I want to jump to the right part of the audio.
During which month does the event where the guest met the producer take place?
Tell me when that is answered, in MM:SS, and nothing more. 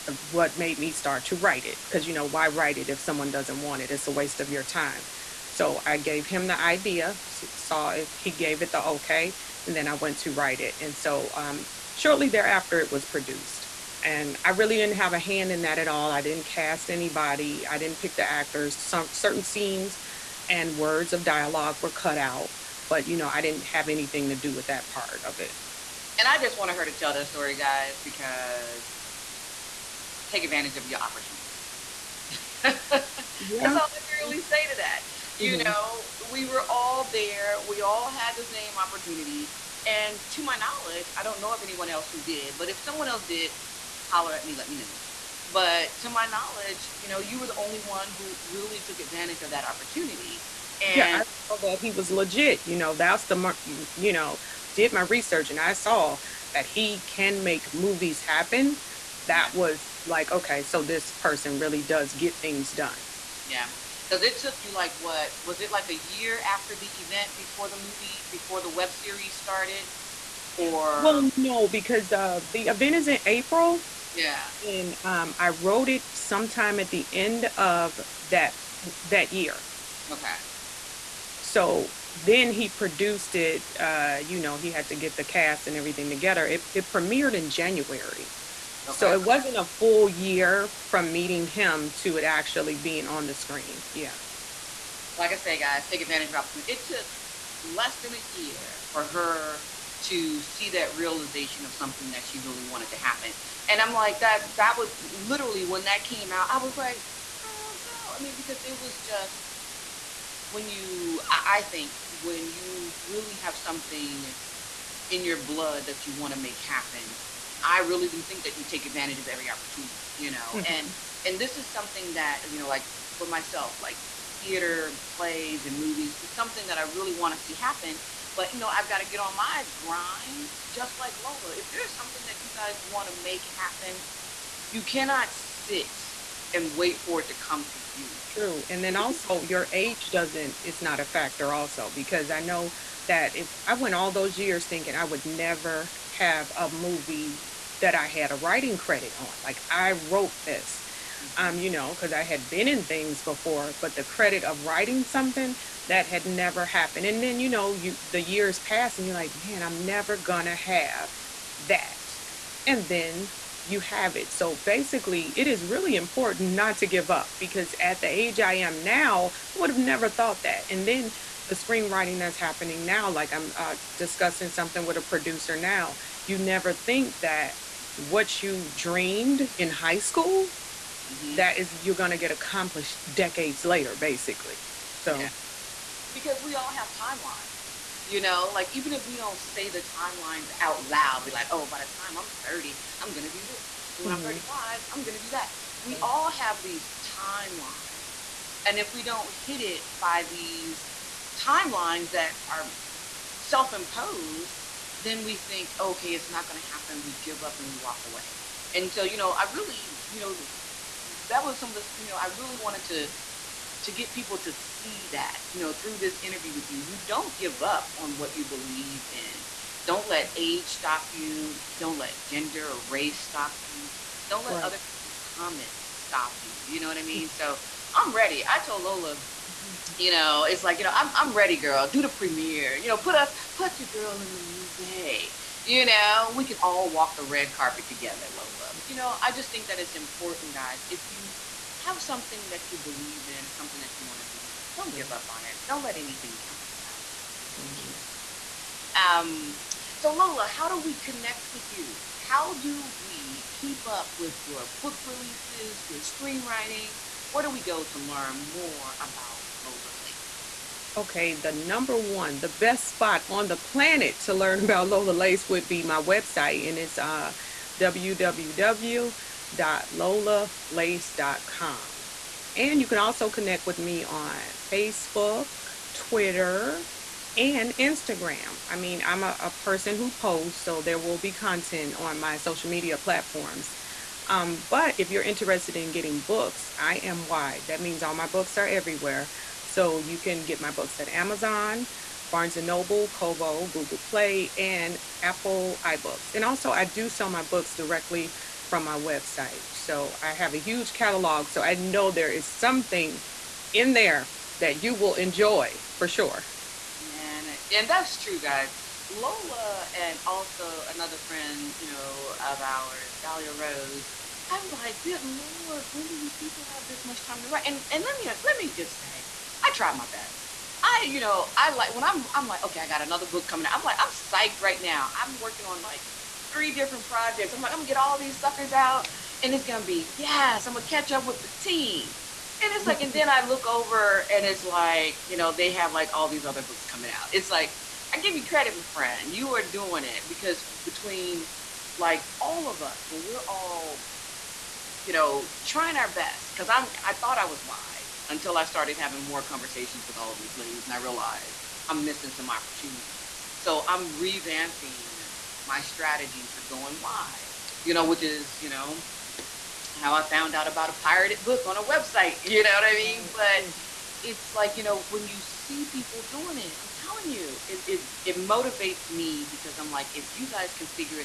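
01:13.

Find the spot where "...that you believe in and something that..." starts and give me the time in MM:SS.
04:02.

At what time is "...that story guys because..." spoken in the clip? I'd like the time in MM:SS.
00:27.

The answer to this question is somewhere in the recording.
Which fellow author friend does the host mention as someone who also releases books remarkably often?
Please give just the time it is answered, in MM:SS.
05:13.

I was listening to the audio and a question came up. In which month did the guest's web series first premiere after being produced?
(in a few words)
January.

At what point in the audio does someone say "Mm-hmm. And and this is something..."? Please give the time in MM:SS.
02:00.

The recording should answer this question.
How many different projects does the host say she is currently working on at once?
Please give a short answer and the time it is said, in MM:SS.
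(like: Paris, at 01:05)
3, at 05:26.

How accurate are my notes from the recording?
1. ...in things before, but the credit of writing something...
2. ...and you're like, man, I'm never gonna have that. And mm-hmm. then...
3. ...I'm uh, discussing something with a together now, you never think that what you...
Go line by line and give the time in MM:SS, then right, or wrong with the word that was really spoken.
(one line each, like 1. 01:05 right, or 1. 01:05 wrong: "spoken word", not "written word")
1. 02:32 right
2. 02:38 right
3. 02:53 wrong: "producer", not "together".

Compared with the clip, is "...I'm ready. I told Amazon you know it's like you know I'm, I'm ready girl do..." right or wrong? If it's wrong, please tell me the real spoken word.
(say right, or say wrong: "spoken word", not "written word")
wrong: "Lolah", not "Amazon".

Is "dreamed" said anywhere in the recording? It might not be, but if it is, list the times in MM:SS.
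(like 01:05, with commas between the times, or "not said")
02:58.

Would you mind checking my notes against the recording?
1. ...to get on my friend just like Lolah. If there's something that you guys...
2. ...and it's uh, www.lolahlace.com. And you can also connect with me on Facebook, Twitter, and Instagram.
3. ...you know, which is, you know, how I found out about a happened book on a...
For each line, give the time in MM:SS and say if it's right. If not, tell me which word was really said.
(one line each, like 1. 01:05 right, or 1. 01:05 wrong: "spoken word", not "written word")
1. 02:09 wrong: "grind", not "friend"
2. 04:26 right
3. 05:57 wrong: "pirated", not "happened".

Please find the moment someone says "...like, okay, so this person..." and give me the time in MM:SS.
01:00.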